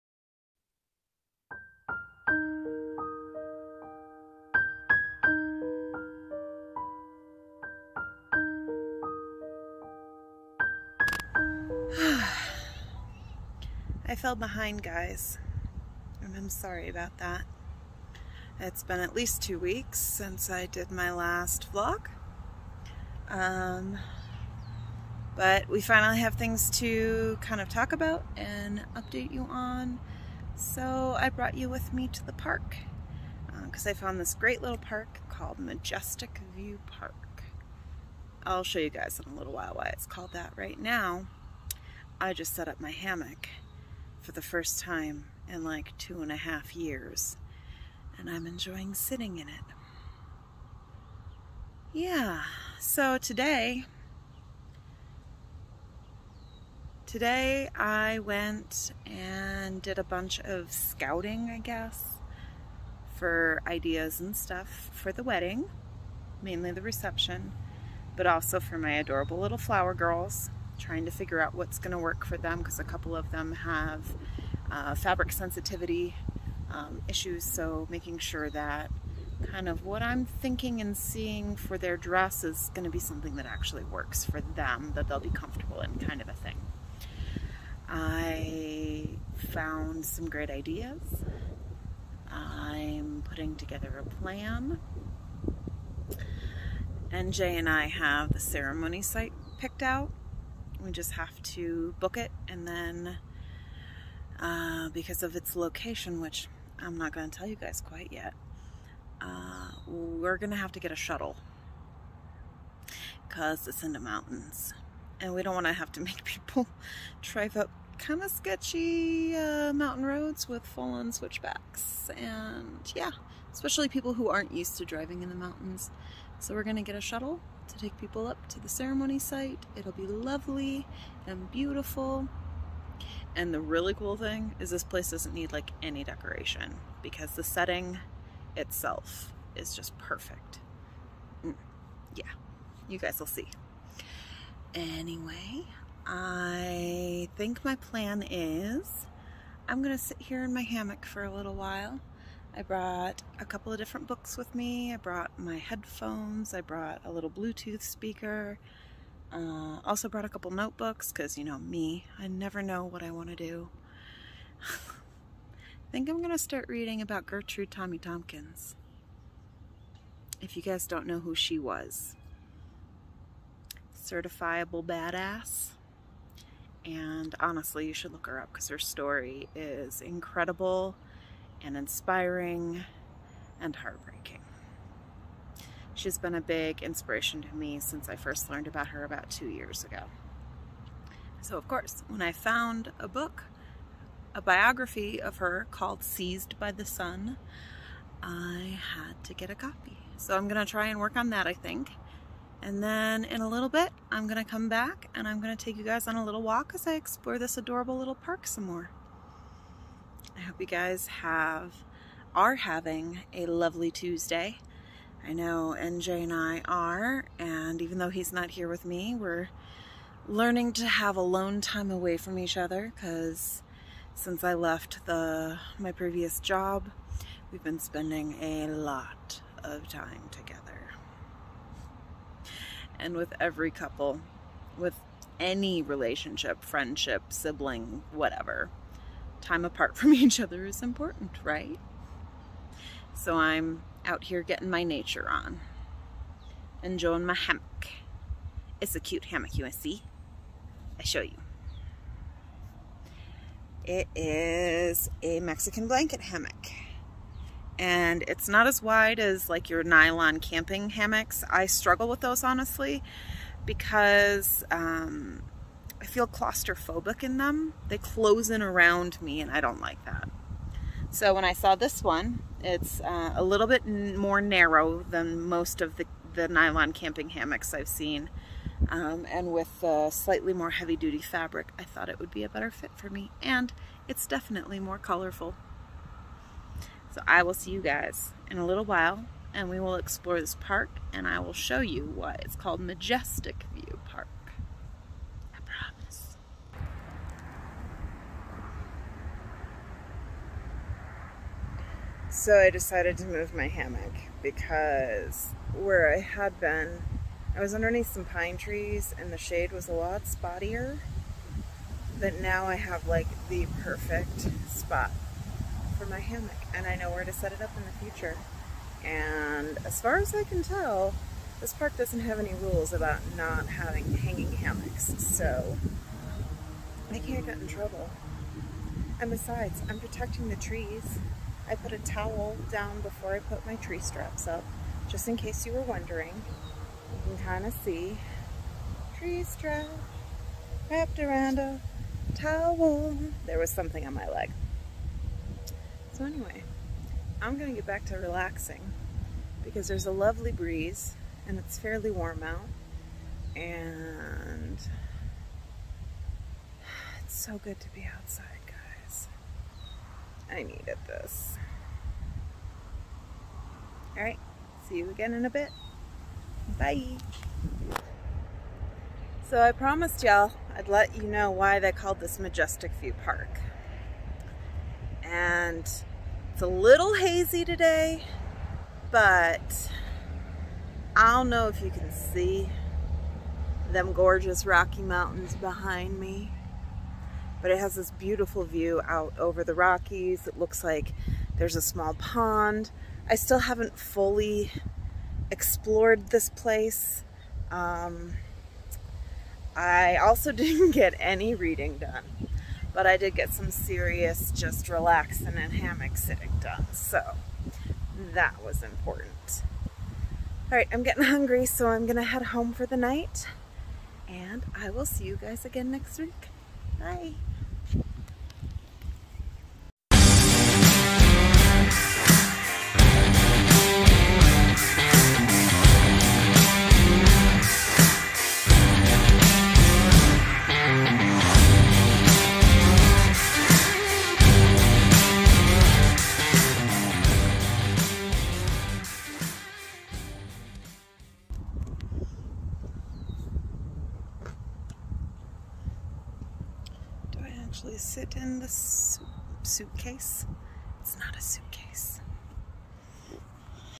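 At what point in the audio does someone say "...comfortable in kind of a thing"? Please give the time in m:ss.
1:25.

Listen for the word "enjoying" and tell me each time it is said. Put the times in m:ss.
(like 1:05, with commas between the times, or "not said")
0:48, 4:06.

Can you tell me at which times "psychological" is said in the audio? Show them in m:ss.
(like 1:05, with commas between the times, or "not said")
not said.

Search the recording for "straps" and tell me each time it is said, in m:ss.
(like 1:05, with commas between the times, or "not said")
5:33, 5:39.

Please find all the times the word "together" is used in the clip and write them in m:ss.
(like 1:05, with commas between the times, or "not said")
1:33, 3:50.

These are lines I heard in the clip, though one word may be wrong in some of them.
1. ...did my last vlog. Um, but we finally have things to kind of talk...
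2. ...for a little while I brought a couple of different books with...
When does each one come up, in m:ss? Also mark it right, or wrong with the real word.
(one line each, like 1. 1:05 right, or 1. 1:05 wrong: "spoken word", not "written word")
1. 0:20 right
2. 2:31 right.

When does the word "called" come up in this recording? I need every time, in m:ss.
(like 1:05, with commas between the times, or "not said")
0:35, 0:40, 3:15, 4:52, 6:11.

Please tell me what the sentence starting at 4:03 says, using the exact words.
So I'm out here getting my nature on.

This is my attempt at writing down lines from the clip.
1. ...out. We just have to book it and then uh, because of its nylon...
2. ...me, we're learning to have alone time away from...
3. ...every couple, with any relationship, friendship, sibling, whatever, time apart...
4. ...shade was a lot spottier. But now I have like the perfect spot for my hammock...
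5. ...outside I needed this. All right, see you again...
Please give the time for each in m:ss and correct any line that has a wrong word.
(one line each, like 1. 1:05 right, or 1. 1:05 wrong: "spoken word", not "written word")
1. 1:39 wrong: "location", not "nylon"
2. 3:38 right
3. 3:53 right
4. 5:09 right
5. 5:58 right.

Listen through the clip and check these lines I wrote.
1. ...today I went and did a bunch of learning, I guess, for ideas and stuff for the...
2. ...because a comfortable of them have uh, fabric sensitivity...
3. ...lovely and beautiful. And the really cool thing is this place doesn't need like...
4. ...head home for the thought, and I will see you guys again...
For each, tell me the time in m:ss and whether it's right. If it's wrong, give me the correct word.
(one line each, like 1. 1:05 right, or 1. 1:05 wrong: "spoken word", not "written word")
1. 0:57 wrong: "scouting", not "learning"
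2. 1:12 wrong: "couple", not "comfortable"
3. 2:10 right
4. 6:52 wrong: "night", not "thought".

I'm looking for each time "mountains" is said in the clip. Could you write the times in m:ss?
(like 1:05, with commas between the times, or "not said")
1:53, 1:59, 2:05, 6:25.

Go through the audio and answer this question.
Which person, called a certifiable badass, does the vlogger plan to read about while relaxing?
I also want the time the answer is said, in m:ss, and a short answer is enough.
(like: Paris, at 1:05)
Gertrude Tommy Tompkins, at 2:47.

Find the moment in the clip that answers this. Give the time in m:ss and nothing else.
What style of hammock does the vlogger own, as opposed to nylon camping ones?
4:15.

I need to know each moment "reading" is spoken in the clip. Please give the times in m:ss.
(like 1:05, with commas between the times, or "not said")
2:46, 6:41.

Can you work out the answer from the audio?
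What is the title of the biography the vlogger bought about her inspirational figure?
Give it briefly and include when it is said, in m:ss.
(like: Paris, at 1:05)
Seized by the Sun, at 3:16.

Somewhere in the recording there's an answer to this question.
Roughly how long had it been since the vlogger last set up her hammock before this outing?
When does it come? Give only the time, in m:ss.
0:45.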